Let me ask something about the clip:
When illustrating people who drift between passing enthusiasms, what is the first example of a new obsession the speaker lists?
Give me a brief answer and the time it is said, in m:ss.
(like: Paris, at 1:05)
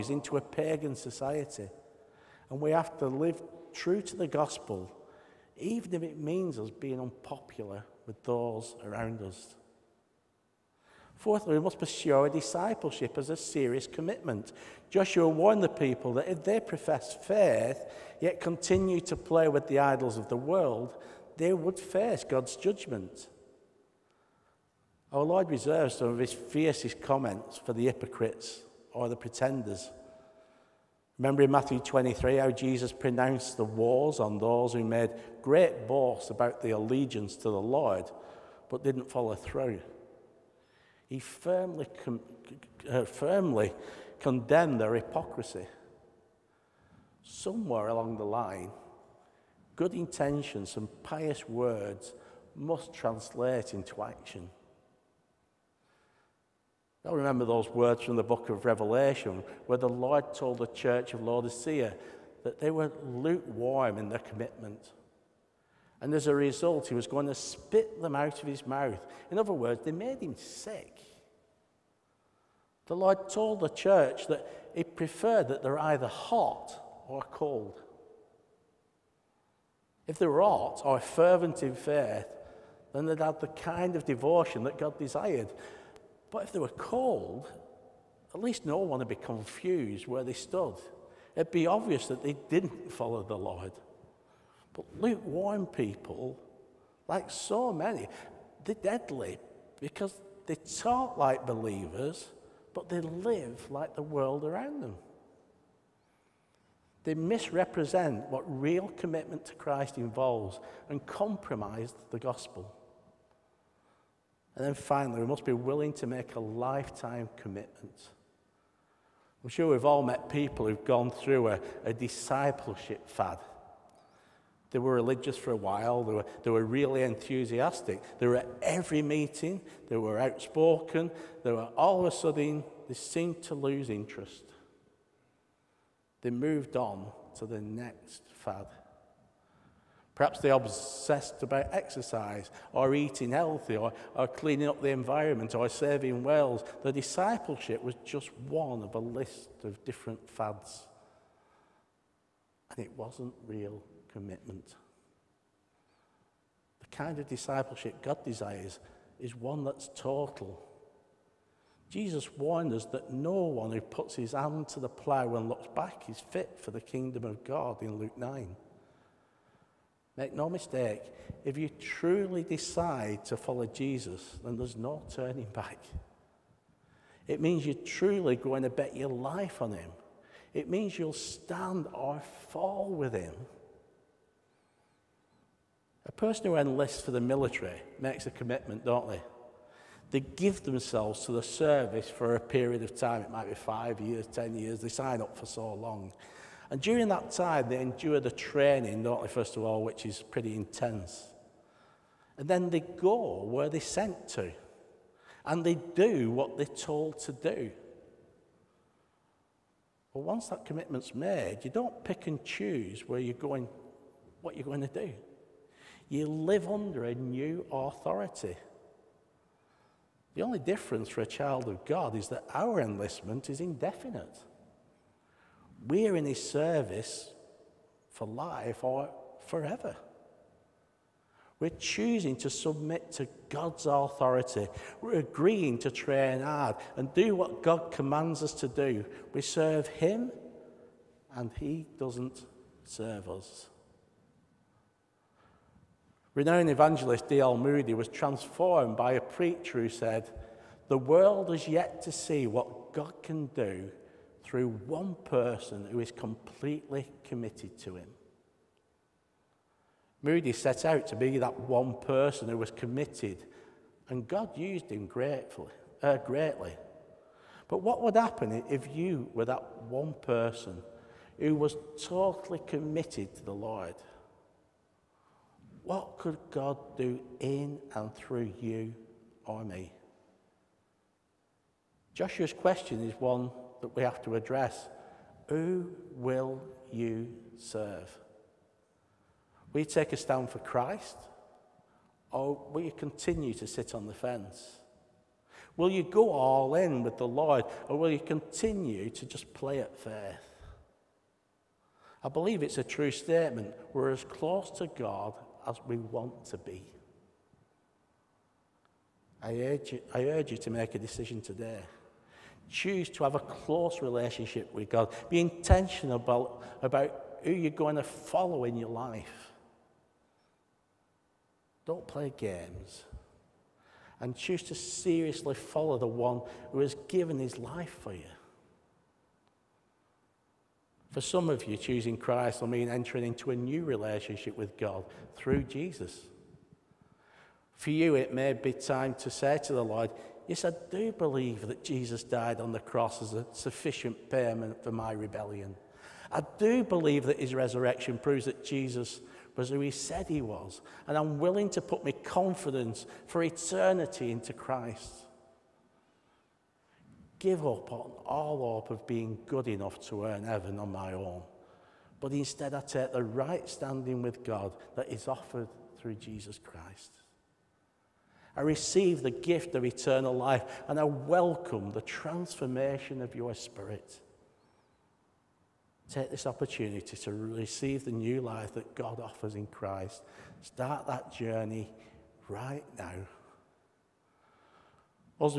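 Exercise, at 2:21.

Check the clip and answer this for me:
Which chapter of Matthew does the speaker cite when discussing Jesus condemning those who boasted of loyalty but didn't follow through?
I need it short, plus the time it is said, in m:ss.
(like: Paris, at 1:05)
Matthew 23, at 0:31.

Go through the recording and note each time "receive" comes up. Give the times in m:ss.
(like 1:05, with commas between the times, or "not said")
6:08, 6:17.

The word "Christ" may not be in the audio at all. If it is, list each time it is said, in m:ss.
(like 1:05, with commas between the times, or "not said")
1:49, 4:50, 5:32, 5:54, 6:06, 6:19.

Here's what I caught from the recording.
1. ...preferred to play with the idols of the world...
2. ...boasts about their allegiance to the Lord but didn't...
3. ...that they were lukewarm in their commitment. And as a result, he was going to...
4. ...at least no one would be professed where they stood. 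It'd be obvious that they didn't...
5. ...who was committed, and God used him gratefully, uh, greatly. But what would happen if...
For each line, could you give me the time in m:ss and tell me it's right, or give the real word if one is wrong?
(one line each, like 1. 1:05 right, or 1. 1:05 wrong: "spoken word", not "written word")
1. 0:18 wrong: "continued", not "preferred"
2. 0:35 right
3. 1:02 right
4. 1:28 wrong: "confused", not "professed"
5. 4:22 right.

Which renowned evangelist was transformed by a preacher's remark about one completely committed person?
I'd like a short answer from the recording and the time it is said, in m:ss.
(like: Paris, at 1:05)
D.L. Moody, at 4:07.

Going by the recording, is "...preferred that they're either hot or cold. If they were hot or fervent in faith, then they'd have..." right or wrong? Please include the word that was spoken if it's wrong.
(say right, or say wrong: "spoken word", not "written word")
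right.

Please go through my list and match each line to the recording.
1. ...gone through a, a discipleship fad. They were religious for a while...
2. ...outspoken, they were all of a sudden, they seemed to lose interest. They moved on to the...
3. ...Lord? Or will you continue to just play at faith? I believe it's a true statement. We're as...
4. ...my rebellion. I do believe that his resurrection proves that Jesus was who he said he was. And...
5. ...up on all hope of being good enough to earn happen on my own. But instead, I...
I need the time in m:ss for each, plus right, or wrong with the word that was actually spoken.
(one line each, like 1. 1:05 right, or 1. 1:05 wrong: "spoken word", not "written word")
1. 2:00 right
2. 2:10 right
3. 4:57 right
4. 5:44 right
5. 5:57 wrong: "heaven", not "happen".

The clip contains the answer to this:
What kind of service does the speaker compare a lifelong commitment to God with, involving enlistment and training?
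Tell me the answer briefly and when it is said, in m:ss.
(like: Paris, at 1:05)
The military, at 3:07.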